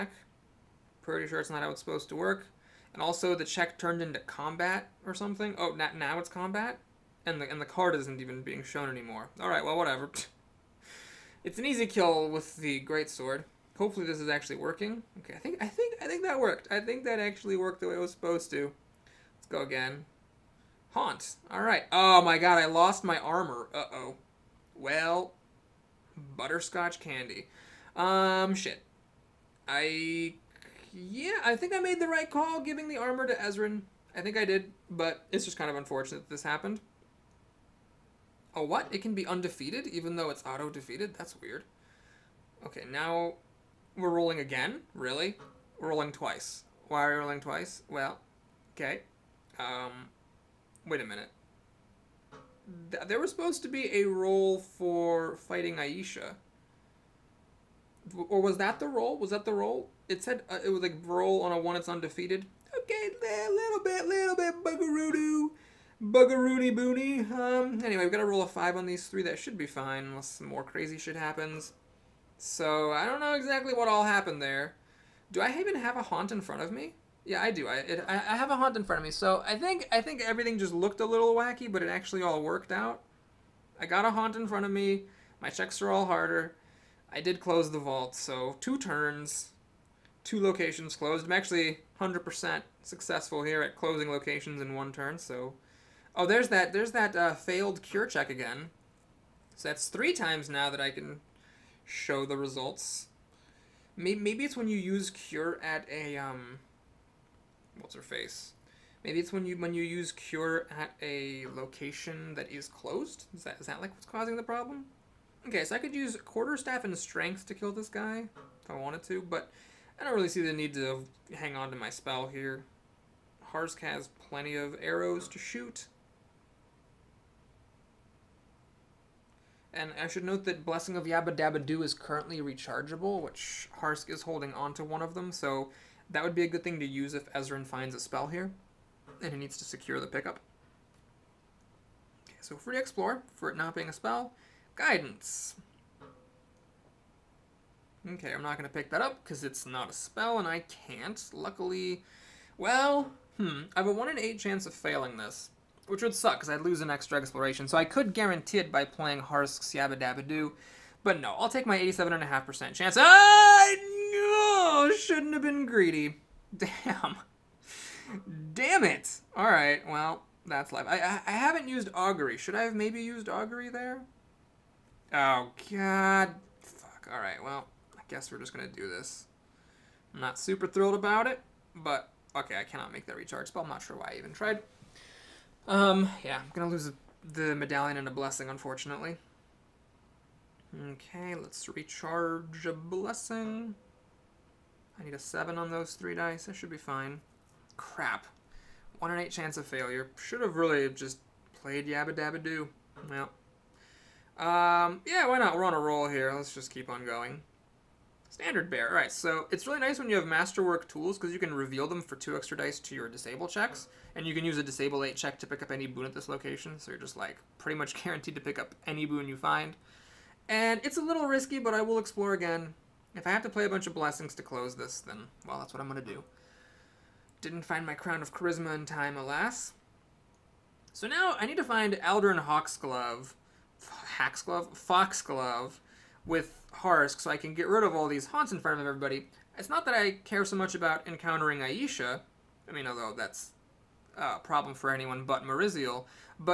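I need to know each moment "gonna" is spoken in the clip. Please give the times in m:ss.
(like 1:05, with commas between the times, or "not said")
3:06, 3:45.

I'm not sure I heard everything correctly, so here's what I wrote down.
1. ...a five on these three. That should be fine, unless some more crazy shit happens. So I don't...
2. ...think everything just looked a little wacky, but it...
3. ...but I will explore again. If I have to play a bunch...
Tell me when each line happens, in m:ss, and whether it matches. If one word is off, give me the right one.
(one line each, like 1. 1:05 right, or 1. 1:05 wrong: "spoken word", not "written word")
1. 1:08 right
2. 1:20 right
3. 3:41 right.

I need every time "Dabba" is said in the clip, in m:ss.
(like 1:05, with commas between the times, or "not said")
2:11, 2:39, 3:22.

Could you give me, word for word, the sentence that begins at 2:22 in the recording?
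Okay, so free explore, for it not being a spell, guidance.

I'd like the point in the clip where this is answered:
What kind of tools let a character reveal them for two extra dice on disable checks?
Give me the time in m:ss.
3:30.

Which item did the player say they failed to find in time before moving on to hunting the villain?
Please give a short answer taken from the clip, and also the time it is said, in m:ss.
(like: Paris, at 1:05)
crown of charisma, at 3:47.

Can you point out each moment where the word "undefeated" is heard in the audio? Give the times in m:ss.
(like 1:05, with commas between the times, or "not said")
0:39, 1:01.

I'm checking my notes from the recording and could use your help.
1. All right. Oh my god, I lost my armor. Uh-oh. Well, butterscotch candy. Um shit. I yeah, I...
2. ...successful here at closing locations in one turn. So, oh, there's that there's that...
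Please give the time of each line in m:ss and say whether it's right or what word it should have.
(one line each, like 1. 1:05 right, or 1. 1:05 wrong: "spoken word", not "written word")
1. 0:21 right
2. 1:32 right.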